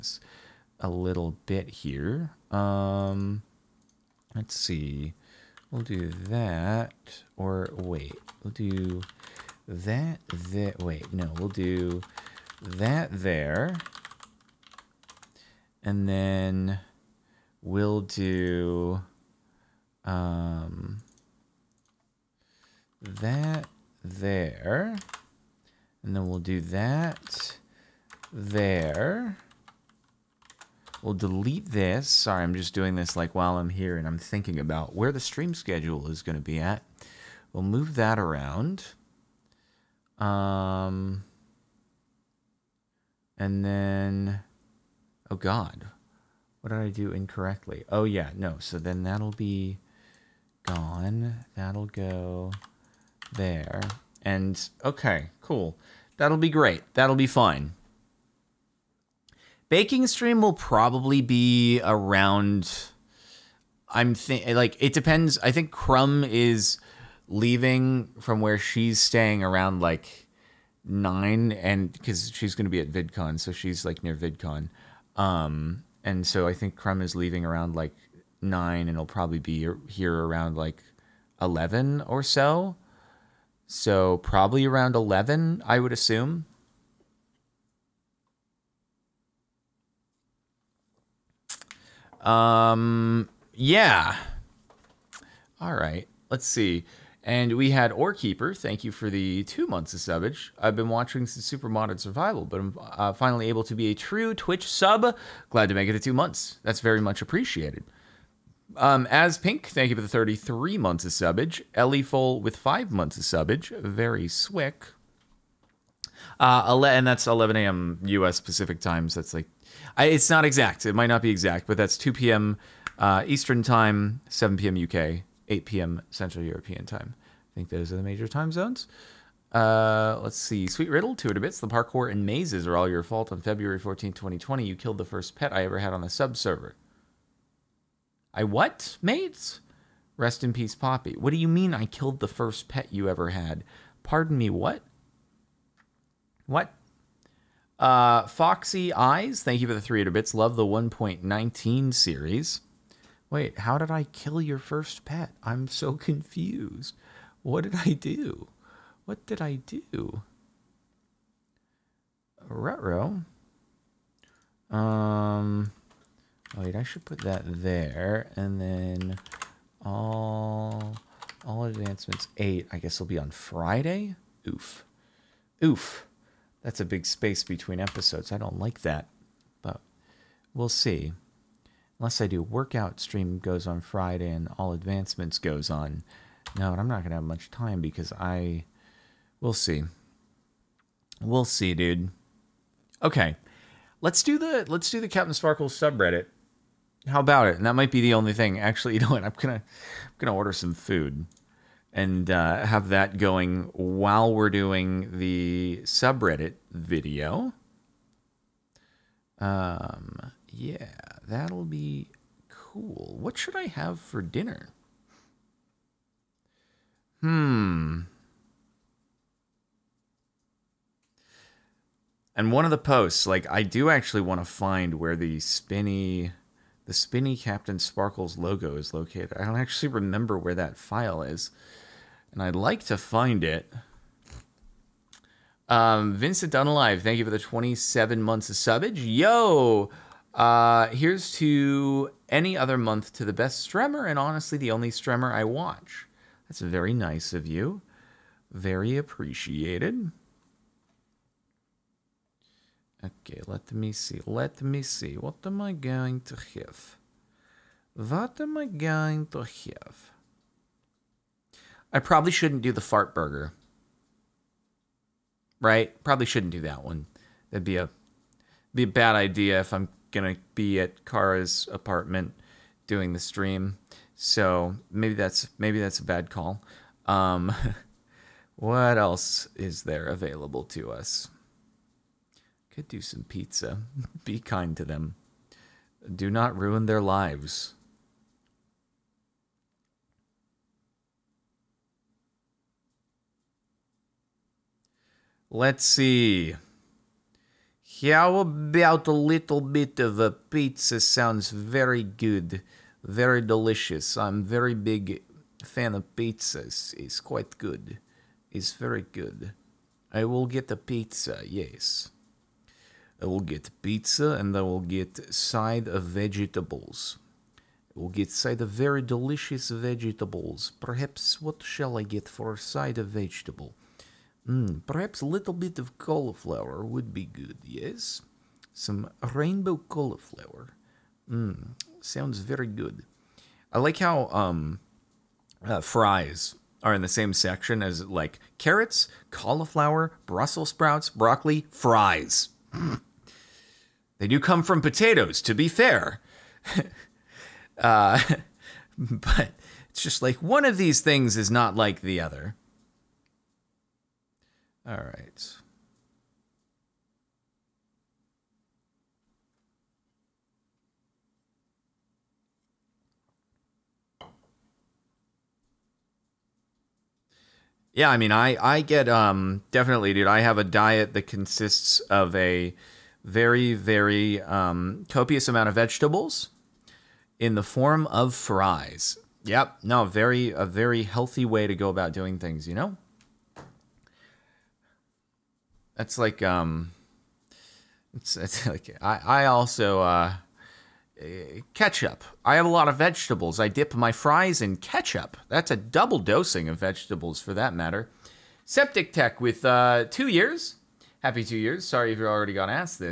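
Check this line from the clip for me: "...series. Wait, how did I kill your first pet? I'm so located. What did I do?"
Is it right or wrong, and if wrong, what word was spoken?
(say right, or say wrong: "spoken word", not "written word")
wrong: "confused", not "located".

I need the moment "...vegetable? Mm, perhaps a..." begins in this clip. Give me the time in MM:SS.
05:23.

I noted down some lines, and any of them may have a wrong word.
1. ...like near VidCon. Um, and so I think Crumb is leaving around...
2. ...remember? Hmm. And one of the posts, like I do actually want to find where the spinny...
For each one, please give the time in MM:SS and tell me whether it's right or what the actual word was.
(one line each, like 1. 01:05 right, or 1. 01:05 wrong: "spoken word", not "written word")
1. 01:13 right
2. 03:34 wrong: "dinner", not "remember".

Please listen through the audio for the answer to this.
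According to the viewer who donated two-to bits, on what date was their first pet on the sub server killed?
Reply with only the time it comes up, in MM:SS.
02:13.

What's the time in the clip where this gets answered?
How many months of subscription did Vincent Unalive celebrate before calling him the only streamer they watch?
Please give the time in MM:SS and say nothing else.
03:57.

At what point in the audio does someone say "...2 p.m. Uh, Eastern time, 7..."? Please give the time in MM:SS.
02:01.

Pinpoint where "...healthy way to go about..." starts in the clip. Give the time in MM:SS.
06:21.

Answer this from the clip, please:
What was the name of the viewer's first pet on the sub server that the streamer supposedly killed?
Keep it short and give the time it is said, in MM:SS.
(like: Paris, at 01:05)
Poppy, at 02:20.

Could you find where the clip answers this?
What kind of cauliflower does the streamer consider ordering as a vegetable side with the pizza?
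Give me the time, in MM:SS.
05:29.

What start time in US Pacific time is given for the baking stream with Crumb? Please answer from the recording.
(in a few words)
11 a.m.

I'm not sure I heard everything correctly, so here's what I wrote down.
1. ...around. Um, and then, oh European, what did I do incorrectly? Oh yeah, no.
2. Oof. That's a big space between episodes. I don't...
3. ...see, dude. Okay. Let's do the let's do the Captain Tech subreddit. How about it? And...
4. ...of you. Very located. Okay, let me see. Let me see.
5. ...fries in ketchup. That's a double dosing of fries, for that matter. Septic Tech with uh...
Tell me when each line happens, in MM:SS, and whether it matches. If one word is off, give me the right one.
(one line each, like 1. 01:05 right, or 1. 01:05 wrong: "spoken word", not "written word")
1. 00:38 wrong: "God", not "European"
2. 02:55 right
3. 03:11 wrong: "Sparkle", not "Tech"
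4. 04:07 wrong: "appreciated", not "located"
5. 06:34 wrong: "vegetables", not "fries".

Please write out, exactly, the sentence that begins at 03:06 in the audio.
No, and I'm not going to have much time because I...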